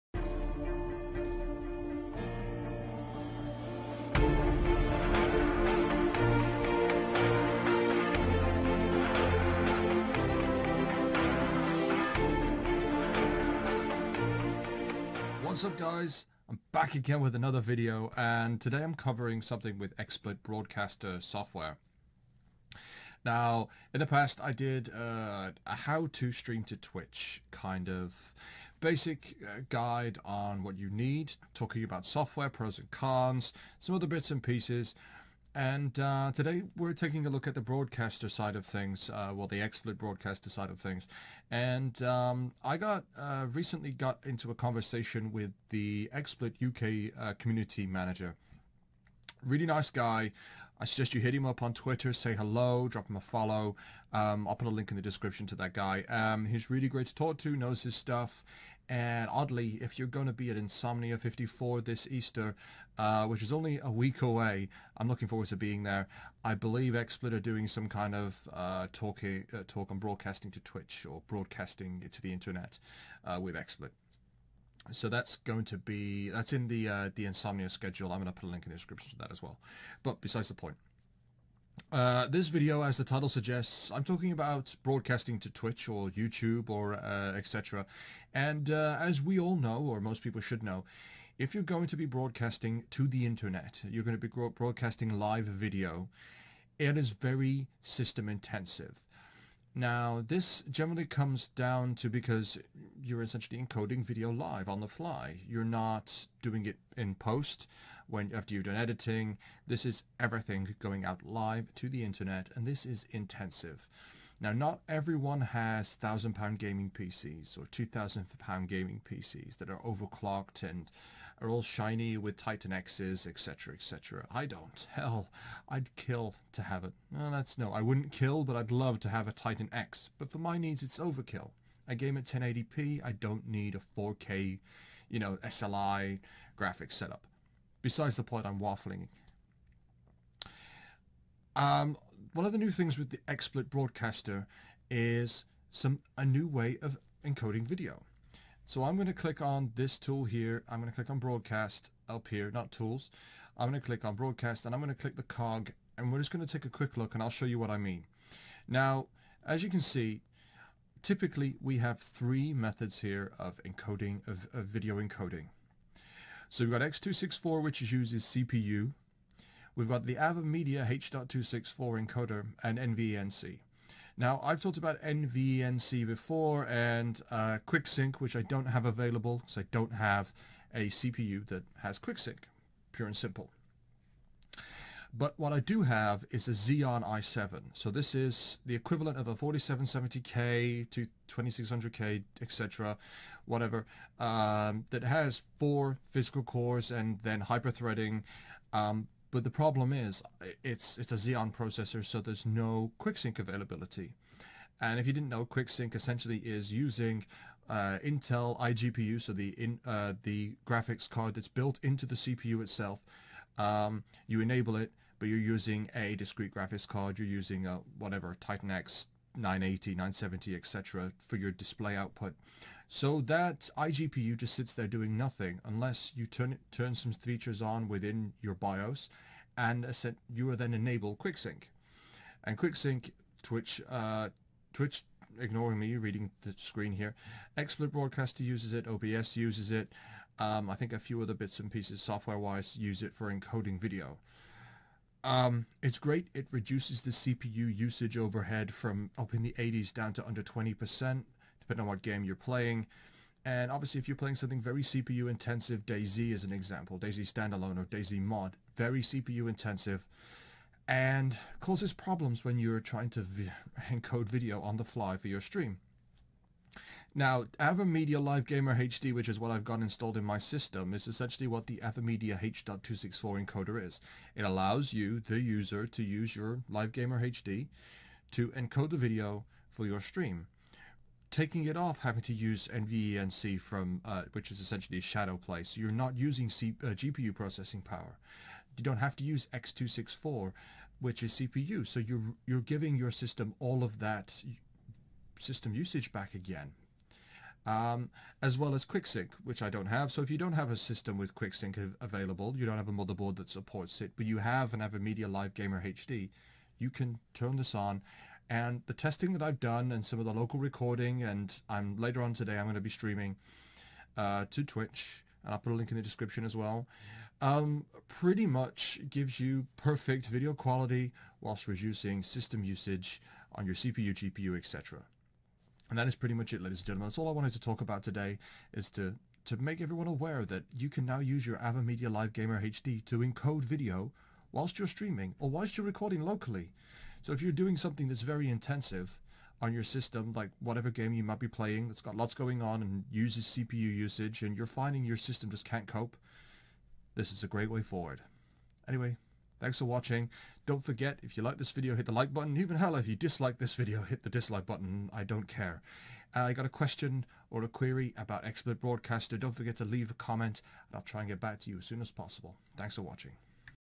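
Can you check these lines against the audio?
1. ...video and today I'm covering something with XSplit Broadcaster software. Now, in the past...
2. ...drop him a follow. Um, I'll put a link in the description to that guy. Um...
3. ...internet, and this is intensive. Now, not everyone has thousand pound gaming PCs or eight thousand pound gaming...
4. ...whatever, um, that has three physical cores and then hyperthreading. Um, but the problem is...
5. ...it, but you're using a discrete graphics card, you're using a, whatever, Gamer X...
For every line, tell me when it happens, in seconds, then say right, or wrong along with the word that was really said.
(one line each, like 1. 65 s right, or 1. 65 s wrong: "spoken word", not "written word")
1. 17 s right
2. 52 s right
3. 112 s wrong: "two", not "eight"
4. 193 s wrong: "four", not "three"
5. 214 s wrong: "Titan", not "Gamer".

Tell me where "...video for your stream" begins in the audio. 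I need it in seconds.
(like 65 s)
278 s.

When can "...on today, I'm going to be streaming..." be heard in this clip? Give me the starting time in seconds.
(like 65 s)
312 s.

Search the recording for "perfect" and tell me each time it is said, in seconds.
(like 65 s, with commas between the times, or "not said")
319 s.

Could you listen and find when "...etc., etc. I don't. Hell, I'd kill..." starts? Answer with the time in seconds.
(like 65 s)
123 s.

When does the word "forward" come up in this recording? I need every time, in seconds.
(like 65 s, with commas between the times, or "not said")
65 s, 347 s.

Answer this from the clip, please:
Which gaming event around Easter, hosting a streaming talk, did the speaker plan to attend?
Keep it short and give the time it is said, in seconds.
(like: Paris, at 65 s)
Insomnia 54, at 60 s.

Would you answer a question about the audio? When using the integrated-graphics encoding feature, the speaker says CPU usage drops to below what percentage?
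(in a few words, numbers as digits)
20%.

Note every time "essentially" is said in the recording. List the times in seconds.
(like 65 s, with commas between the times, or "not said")
103 s, 205 s, 271 s, 284 s.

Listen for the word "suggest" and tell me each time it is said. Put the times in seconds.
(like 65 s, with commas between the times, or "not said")
50 s, 83 s.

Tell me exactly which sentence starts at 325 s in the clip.
And that is pretty much it, ladies and gentlemen.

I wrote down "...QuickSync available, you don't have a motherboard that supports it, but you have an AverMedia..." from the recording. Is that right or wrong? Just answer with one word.
right.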